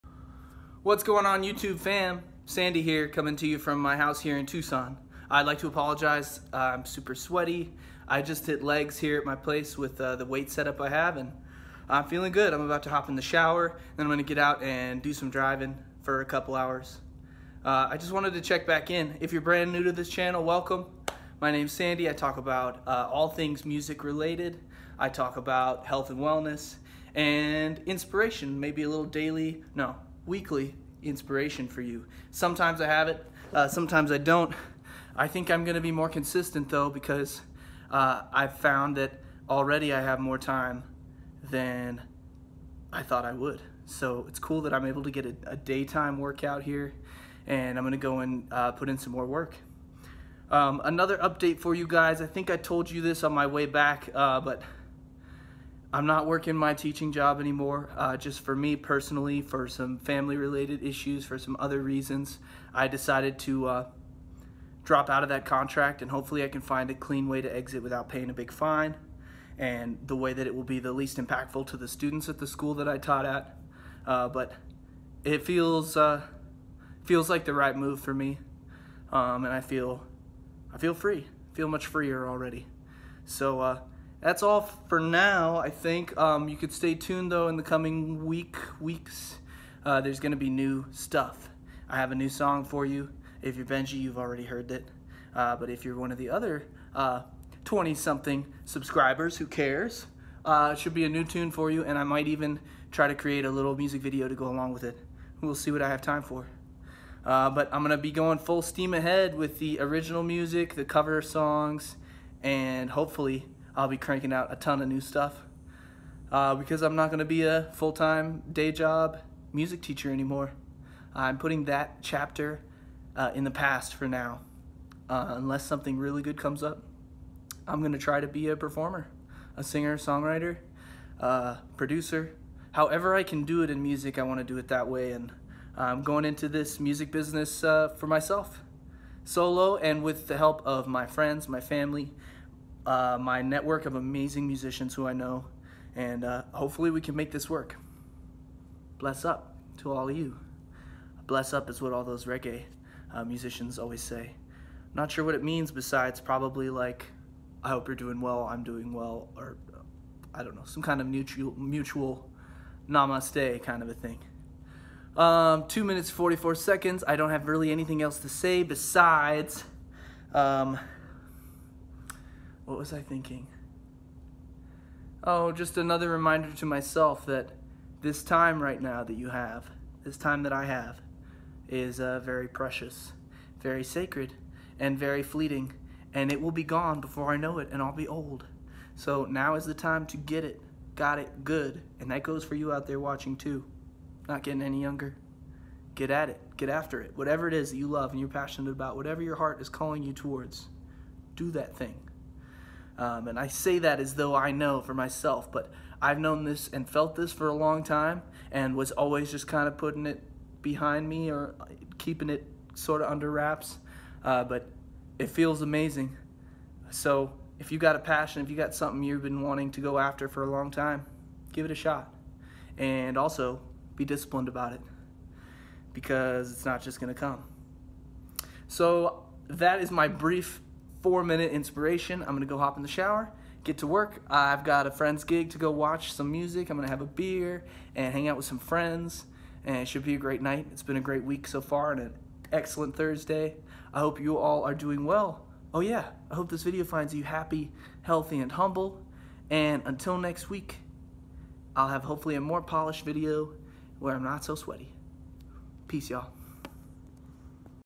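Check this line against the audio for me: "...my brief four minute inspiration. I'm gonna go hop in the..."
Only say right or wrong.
right.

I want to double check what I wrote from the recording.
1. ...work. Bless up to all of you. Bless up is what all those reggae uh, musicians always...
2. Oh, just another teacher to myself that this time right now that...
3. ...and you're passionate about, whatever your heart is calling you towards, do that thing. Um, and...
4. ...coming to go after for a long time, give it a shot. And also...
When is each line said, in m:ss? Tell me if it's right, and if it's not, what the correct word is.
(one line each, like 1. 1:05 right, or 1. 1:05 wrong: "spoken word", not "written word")
1. 2:27 right
2. 2:55 wrong: "reminder", not "teacher"
3. 3:18 right
4. 3:39 wrong: "wanting", not "coming".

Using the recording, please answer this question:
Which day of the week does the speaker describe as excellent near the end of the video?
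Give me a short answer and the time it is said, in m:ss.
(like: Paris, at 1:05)
Thursday, at 4:02.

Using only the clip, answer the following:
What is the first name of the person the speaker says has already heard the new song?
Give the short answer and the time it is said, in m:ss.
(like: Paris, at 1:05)
Benji, at 1:33.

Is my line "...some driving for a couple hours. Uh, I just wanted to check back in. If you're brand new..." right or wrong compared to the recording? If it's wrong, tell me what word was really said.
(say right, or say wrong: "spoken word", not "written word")
right.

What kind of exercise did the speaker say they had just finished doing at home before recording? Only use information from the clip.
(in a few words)
Legs.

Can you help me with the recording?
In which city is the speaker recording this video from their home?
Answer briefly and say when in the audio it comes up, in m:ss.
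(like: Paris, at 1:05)
Tucson, at 0:04.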